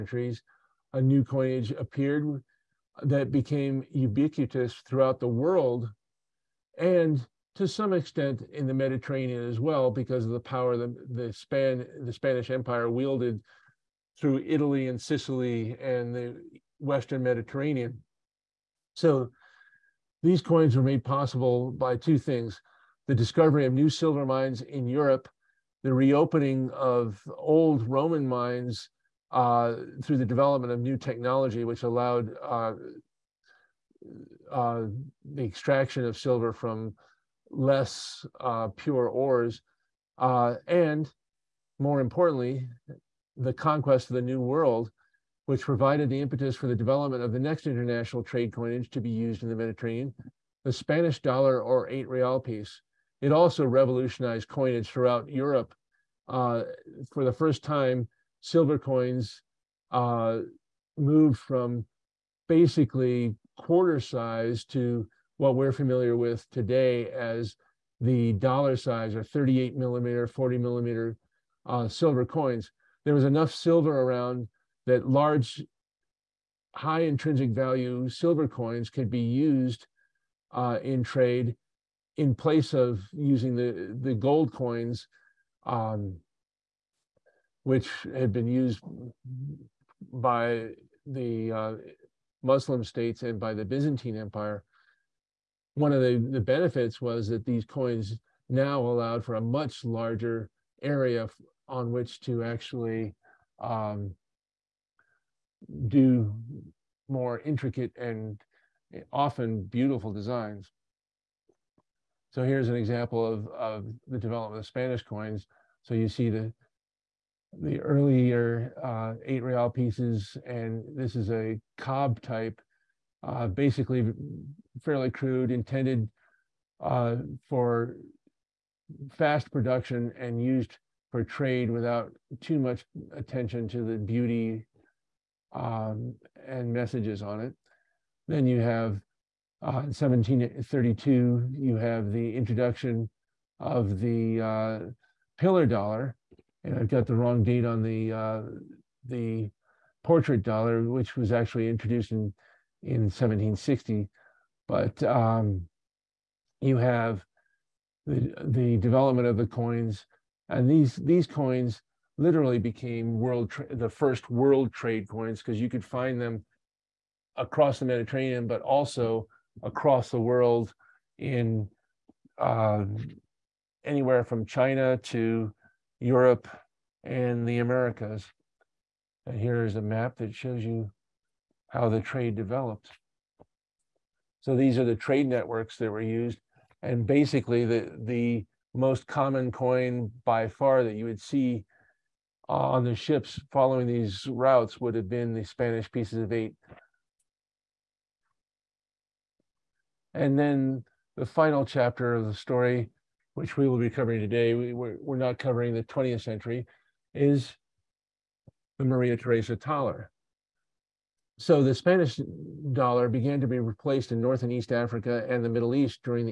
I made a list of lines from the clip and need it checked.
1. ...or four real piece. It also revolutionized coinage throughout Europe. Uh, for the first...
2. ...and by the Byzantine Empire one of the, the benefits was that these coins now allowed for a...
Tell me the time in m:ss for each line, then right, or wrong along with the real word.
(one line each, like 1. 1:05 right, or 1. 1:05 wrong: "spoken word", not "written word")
1. 0:51 wrong: "eight", not "four"
2. 1:33 right.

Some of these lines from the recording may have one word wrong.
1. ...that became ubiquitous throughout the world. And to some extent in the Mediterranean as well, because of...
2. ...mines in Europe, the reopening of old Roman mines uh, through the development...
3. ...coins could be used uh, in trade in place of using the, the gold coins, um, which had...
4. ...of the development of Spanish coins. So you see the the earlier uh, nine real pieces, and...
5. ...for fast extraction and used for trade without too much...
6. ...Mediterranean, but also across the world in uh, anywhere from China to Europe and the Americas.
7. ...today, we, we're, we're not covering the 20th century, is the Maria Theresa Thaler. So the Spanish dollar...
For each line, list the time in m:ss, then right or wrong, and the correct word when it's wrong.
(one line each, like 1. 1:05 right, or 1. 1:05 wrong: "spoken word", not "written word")
1. 0:03 right
2. 0:24 right
3. 1:18 right
4. 1:53 wrong: "eight", not "nine"
5. 2:07 wrong: "production", not "extraction"
6. 2:47 right
7. 3:24 right.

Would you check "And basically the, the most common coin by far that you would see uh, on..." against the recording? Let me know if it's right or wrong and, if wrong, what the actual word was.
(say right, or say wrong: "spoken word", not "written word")
right.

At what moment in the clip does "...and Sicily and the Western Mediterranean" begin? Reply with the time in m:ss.
0:14.